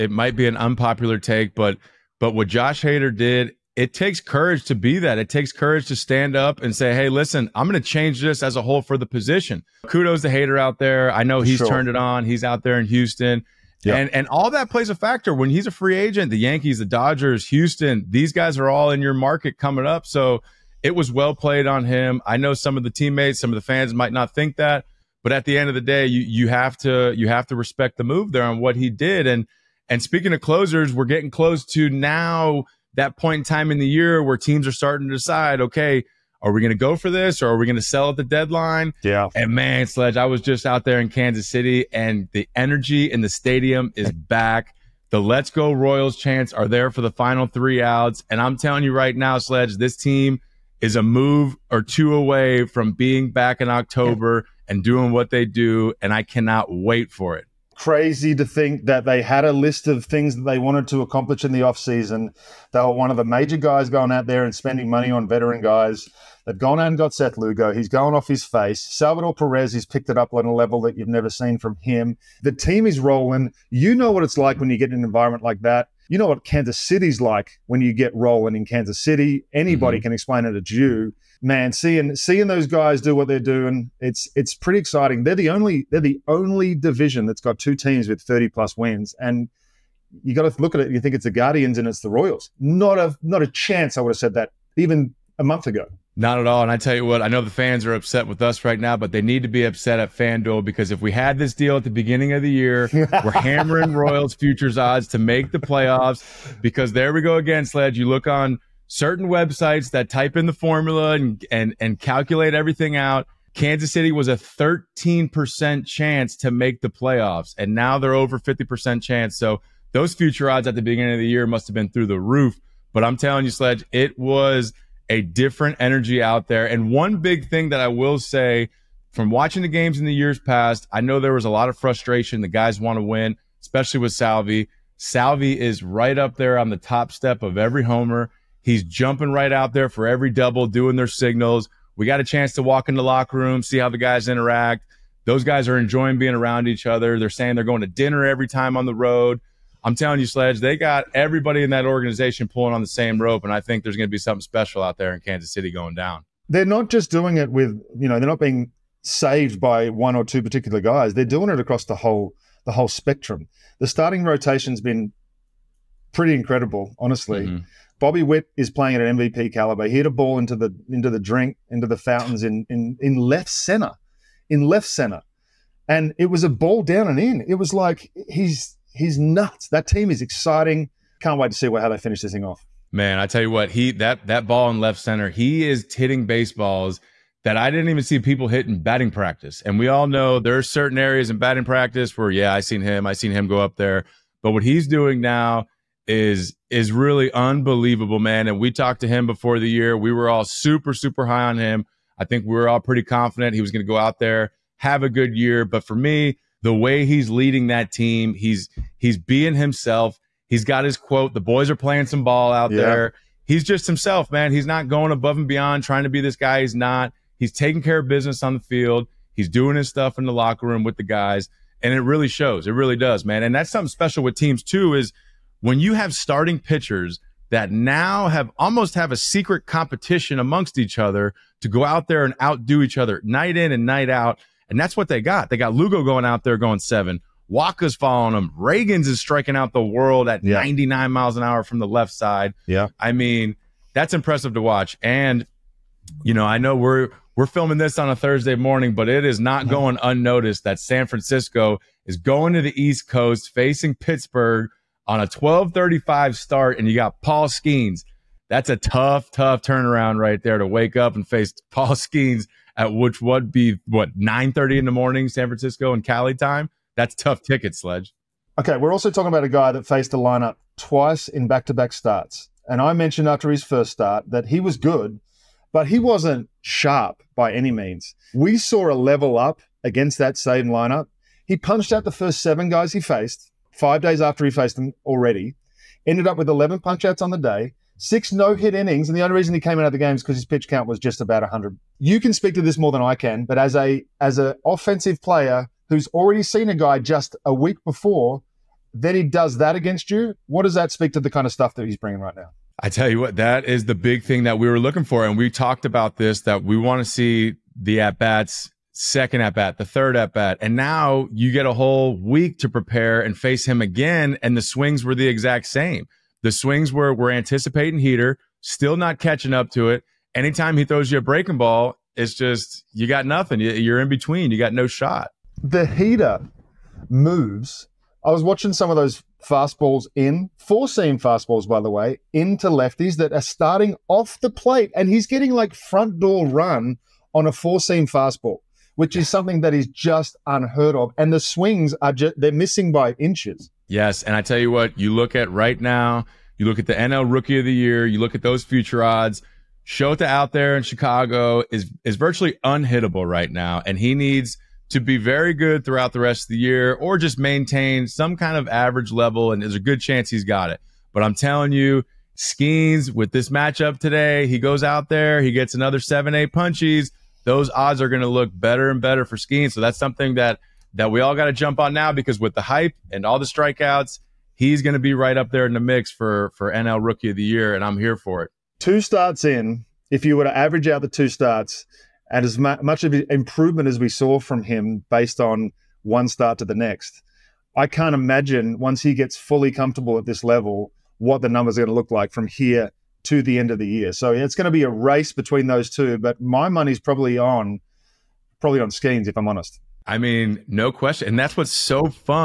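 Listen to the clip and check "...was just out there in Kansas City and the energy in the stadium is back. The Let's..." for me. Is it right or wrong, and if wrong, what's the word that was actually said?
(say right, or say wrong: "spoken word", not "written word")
right.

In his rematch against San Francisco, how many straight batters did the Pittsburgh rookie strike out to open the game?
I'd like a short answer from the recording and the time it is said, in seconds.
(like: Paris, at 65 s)
7, at 282 s.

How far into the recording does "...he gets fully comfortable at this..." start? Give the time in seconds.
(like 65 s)
389 s.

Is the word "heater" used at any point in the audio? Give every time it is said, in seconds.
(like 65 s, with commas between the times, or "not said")
317 s, 325 s.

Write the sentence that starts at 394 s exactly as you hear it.
So it's going to be a race between those two.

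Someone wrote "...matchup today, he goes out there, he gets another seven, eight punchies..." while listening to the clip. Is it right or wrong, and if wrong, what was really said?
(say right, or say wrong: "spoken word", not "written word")
right.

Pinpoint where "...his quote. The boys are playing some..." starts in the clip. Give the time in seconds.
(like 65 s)
210 s.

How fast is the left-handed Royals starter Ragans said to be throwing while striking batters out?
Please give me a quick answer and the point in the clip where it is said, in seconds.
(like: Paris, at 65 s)
99 mph, at 240 s.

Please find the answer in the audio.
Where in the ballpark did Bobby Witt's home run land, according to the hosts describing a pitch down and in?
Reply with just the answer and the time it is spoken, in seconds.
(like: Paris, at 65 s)
the fountains, at 171 s.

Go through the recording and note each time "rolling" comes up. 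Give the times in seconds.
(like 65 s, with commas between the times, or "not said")
72 s, 78 s.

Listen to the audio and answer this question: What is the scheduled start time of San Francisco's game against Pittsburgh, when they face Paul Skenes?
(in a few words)
12:35.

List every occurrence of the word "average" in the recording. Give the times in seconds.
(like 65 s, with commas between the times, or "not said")
358 s, 380 s.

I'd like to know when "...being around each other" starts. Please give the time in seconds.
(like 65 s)
146 s.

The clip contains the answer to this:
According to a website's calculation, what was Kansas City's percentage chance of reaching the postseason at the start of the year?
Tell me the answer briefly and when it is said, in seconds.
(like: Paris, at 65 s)
13%, at 114 s.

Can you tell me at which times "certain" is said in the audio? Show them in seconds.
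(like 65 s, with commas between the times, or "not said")
108 s, 190 s.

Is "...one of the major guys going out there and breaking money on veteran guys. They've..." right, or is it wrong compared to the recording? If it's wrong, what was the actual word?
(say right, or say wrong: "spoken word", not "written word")
wrong: "spending", not "breaking".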